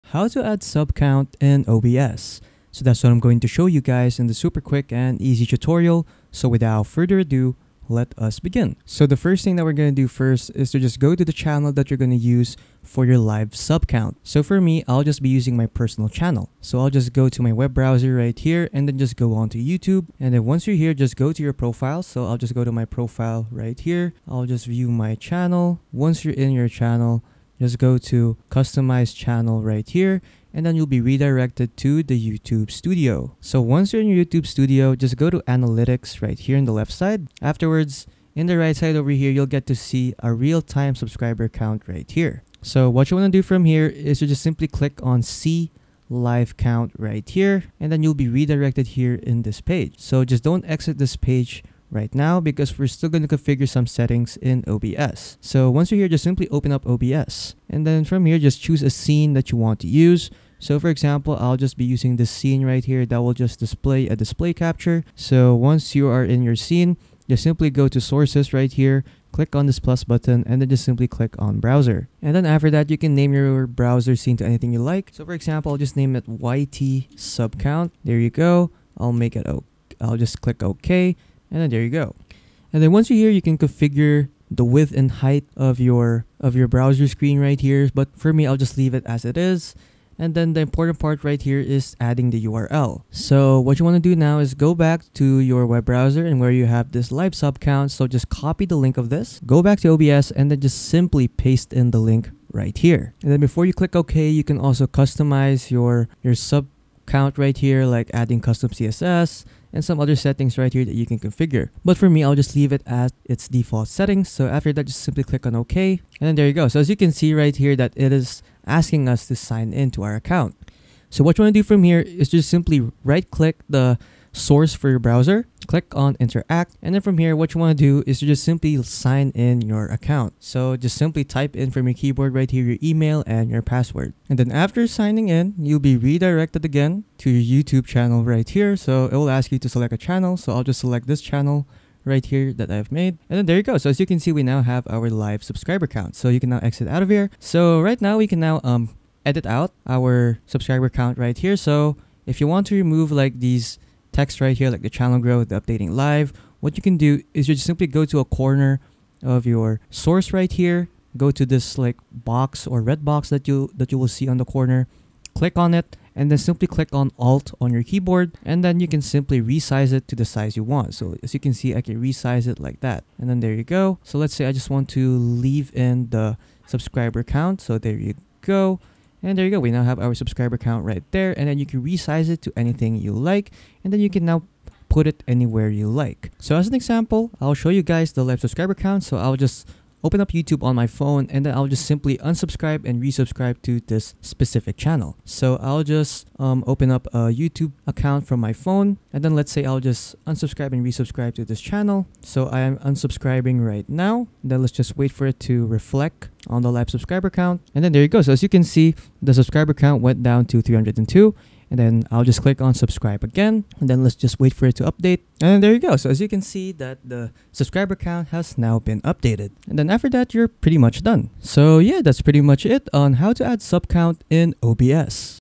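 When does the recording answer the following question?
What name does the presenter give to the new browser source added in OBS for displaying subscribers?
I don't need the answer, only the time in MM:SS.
01:16.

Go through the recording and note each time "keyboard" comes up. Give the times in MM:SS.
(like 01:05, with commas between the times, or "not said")
02:11, 02:47.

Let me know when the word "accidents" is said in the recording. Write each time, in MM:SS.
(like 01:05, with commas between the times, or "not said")
not said.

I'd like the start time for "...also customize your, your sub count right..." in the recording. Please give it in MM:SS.
01:44.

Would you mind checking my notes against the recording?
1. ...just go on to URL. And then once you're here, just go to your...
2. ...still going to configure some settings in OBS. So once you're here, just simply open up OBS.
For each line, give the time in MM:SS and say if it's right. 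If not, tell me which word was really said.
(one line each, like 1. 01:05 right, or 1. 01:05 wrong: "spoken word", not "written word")
1. 00:18 wrong: "YouTube", not "URL"
2. 00:52 right.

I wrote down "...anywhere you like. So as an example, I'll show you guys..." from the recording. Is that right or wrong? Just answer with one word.
right.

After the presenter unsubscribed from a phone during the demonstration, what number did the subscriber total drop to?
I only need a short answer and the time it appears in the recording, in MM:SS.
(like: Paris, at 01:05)
302, at 03:30.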